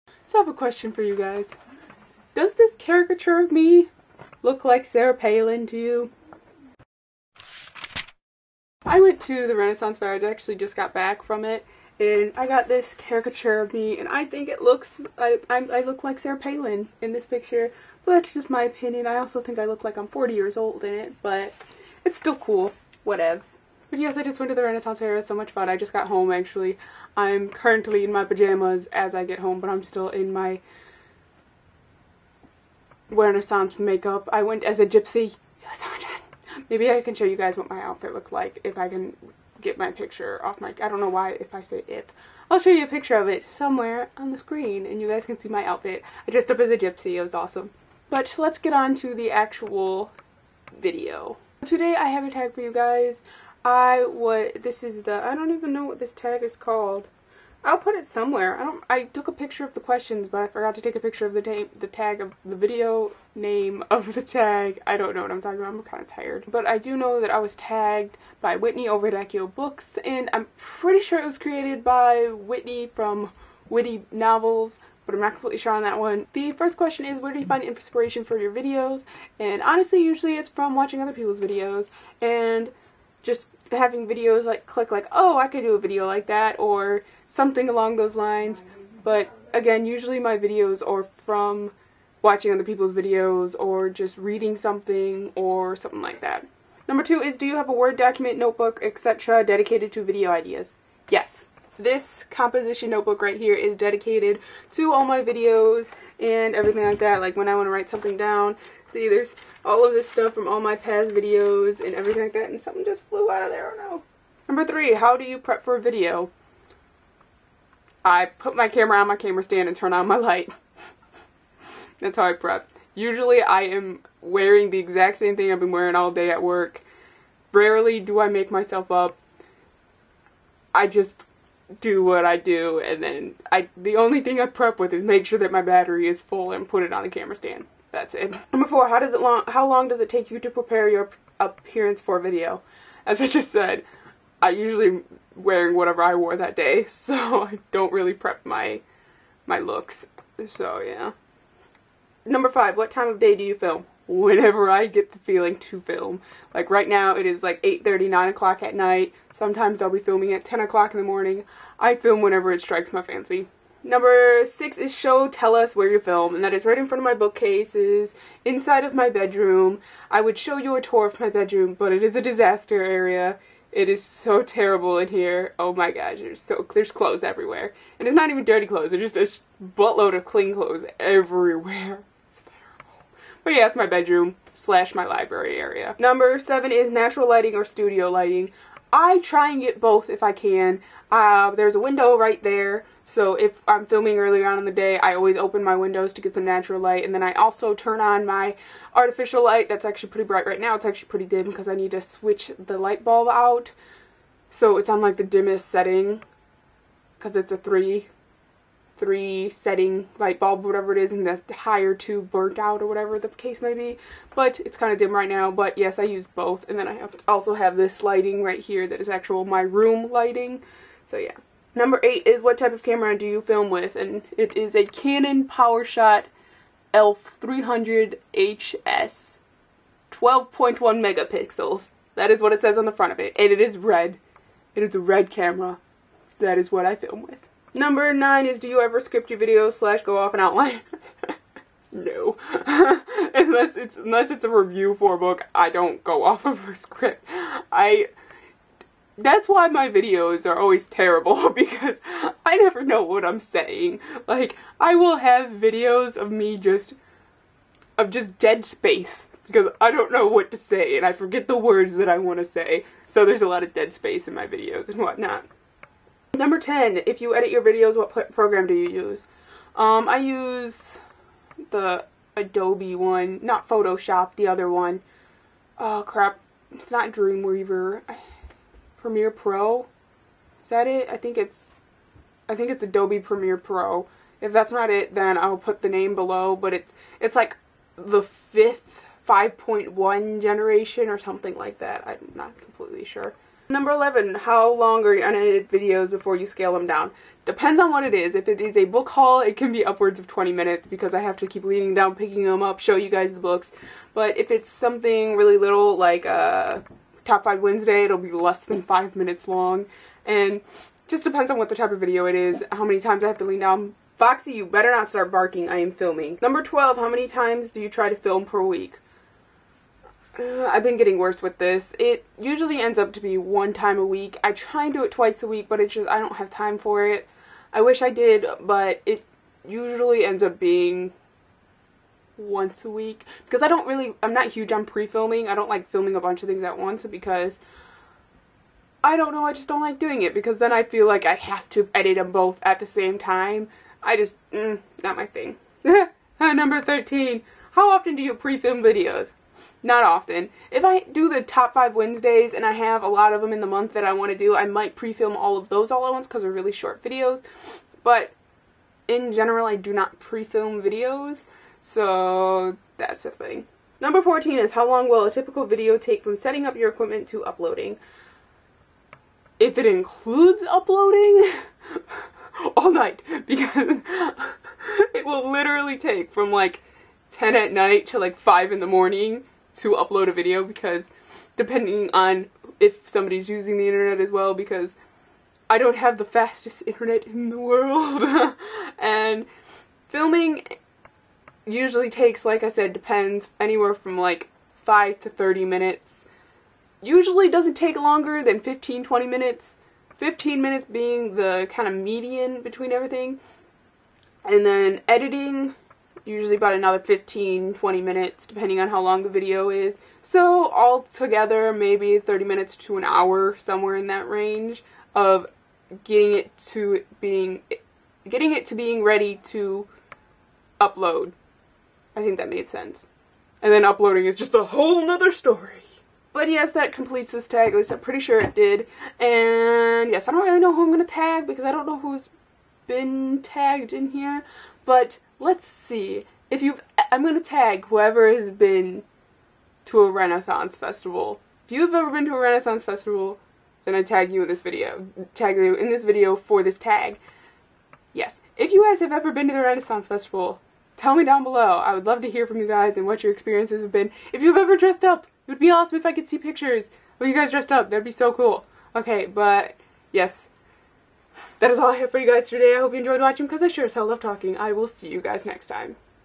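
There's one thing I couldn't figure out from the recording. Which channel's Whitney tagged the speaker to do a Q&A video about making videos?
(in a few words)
Accio Books.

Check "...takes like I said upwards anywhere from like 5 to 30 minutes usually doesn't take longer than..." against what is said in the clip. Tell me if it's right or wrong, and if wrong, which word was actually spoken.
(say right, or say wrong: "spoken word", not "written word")
wrong: "depends", not "upwards".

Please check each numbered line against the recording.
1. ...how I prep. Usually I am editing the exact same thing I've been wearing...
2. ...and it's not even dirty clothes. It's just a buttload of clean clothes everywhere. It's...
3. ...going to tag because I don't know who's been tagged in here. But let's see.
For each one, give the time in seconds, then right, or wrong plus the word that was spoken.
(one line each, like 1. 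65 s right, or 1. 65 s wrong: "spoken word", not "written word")
1. 122 s wrong: "wearing", not "editing"
2. 177 s right
3. 430 s right.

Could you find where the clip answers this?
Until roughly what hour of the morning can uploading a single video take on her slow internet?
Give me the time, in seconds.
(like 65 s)
378 s.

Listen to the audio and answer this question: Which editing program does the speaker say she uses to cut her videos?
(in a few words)
Adobe Premiere Pro.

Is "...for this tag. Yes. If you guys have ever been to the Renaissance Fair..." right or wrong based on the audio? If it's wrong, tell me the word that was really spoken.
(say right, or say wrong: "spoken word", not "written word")
wrong: "Festival", not "Fair".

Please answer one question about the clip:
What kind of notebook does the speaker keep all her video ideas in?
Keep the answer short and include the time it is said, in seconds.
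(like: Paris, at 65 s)
Composition notebook, at 102 s.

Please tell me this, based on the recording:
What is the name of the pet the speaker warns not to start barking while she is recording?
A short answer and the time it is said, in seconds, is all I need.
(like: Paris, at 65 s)
Foxy, at 314 s.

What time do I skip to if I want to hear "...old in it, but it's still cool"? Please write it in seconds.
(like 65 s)
20 s.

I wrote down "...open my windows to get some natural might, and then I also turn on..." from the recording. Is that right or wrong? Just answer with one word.
wrong.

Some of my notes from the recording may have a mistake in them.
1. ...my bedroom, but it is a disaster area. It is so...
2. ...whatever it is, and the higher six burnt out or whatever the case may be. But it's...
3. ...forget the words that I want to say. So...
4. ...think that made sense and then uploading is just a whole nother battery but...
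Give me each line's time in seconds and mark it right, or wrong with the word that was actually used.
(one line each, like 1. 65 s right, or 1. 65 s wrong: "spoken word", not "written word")
1. 171 s right
2. 210 s wrong: "two", not "six"
3. 261 s right
4. 422 s wrong: "story", not "battery".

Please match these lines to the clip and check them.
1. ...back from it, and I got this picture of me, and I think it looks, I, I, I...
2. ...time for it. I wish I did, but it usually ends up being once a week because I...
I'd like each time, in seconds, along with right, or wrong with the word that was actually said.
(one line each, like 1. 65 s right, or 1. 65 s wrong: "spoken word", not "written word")
1. 10 s wrong: "caricature", not "picture"
2. 326 s right.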